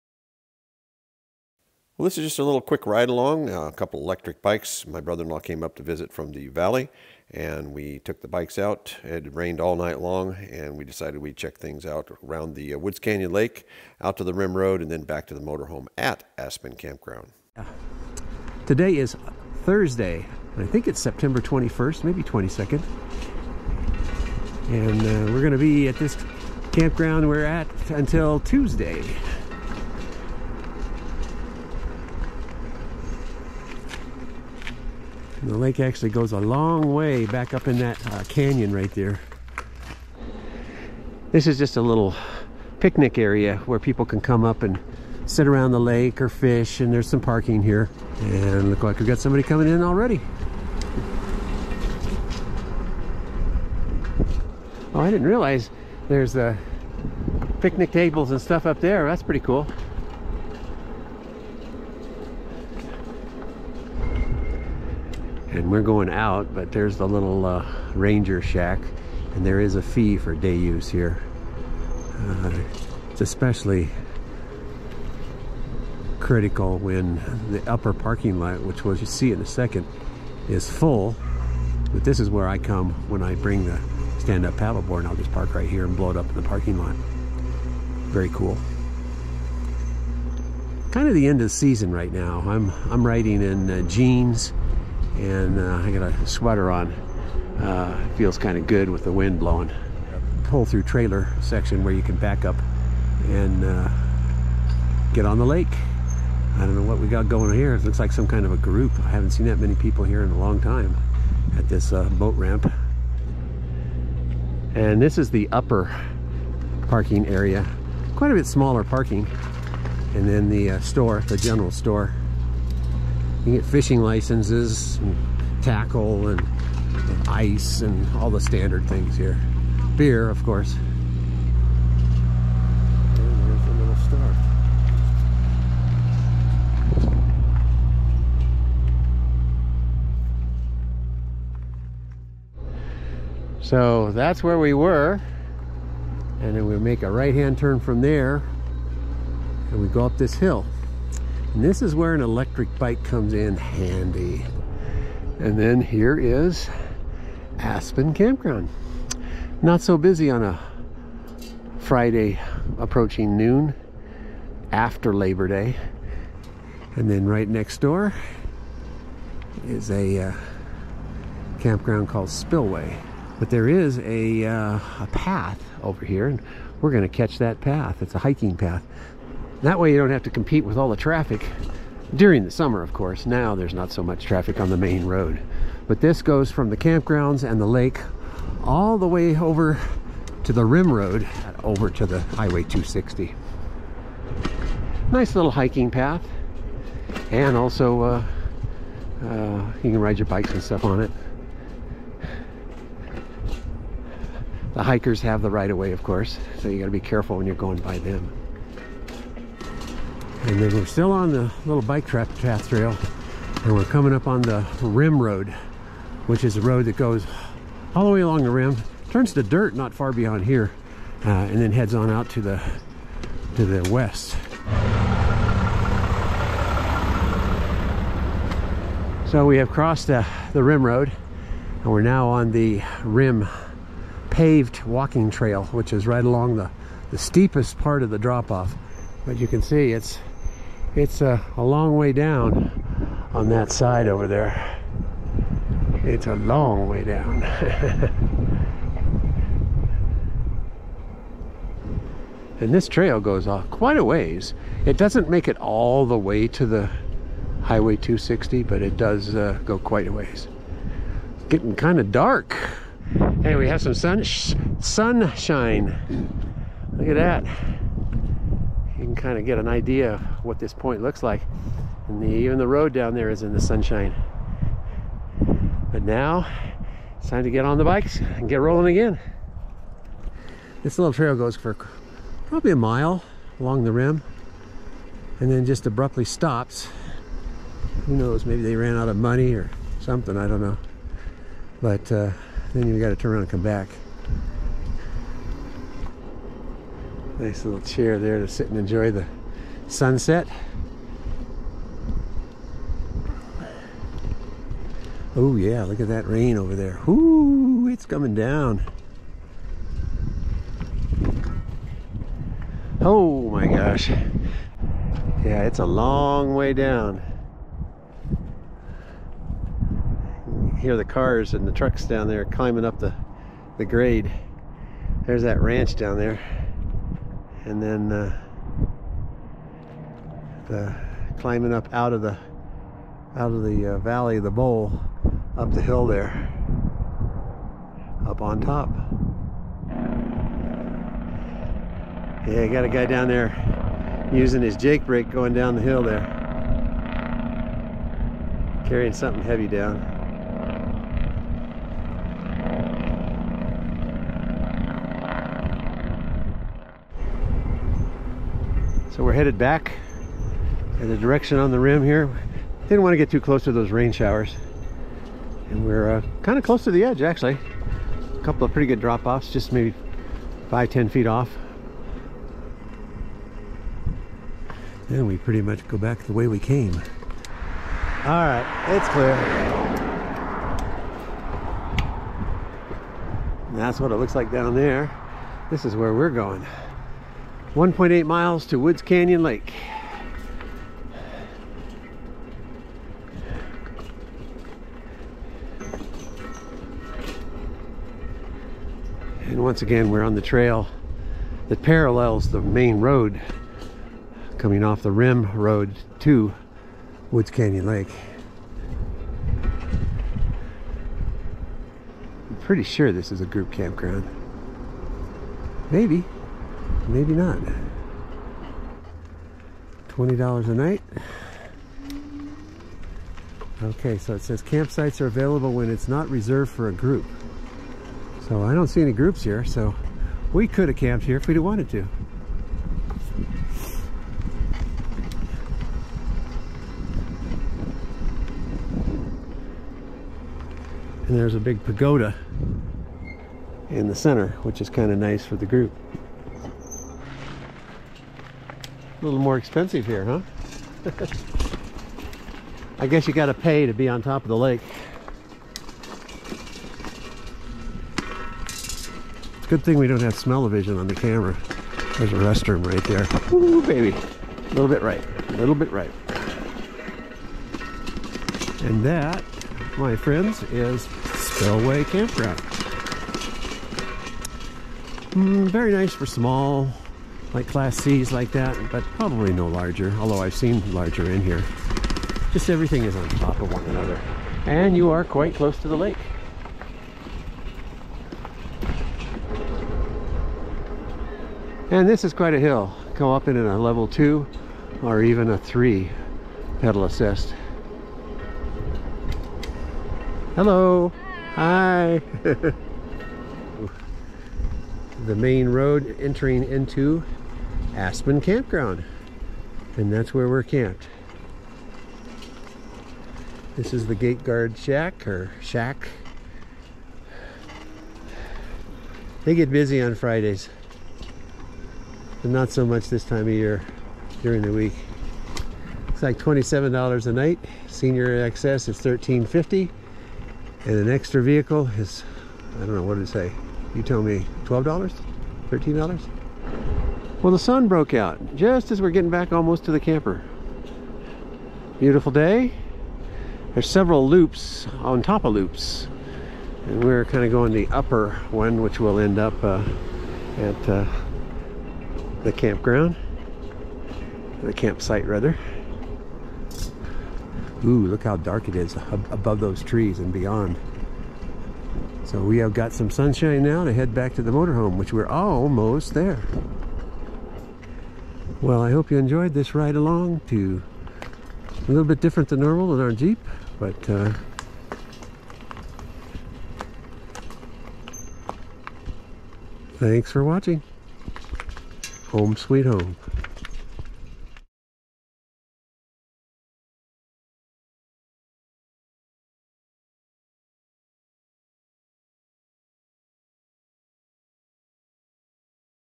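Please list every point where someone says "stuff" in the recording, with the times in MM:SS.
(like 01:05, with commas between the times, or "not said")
00:58, 03:20.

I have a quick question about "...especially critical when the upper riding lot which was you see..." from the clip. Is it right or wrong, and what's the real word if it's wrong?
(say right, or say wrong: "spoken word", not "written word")
wrong: "parking", not "riding".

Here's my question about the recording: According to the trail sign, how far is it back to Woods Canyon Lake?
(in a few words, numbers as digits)
1.8 miles.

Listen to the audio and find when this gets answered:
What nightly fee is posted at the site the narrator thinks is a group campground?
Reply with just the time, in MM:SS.
07:00.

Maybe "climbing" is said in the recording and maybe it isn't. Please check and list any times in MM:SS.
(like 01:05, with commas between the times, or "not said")
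05:22, 05:31.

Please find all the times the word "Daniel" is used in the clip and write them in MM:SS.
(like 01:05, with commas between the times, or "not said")
not said.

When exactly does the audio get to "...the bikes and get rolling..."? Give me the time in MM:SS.
04:37.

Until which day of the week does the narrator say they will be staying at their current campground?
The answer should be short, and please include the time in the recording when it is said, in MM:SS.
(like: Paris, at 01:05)
Tuesday, at 00:28.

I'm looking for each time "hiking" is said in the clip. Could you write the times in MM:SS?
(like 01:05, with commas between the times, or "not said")
02:58, 03:15.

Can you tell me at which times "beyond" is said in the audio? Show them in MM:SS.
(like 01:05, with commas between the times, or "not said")
03:40, 09:20.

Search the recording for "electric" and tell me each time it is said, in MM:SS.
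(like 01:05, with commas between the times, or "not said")
00:04, 02:32.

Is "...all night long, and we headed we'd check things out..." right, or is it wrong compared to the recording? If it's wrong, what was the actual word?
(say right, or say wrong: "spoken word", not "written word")
wrong: "decided", not "headed".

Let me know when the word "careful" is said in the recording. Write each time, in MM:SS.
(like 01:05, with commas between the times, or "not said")
03:26.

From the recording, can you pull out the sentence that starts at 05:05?
Oh yeah, look at that rain over there.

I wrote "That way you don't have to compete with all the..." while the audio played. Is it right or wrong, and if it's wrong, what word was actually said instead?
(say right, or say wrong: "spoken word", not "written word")
right.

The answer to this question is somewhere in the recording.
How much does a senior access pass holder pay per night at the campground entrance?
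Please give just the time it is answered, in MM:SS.
08:48.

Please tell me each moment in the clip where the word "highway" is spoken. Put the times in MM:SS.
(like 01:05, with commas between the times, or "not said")
03:12, 04:17.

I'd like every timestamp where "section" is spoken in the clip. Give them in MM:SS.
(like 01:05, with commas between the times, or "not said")
01:41.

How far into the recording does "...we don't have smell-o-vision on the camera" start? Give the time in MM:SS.
07:39.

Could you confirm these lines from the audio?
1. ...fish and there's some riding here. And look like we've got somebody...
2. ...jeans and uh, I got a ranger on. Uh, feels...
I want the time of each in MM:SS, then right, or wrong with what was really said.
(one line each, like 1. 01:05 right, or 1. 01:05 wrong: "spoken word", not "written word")
1. 00:46 wrong: "parking", not "riding"
2. 01:33 wrong: "sweater", not "ranger".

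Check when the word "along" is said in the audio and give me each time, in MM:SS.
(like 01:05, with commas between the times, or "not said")
00:03, 03:38, 03:56, 04:43, 09:29.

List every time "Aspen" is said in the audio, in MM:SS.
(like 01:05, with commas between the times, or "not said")
00:16, 02:37, 08:27.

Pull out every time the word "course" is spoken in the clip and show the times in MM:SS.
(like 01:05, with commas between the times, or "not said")
02:10, 03:02, 03:26.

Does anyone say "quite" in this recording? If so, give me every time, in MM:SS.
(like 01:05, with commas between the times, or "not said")
01:58, 04:13, 04:19, 08:05, 08:12.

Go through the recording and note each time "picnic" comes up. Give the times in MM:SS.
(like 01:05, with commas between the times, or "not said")
00:42, 00:57.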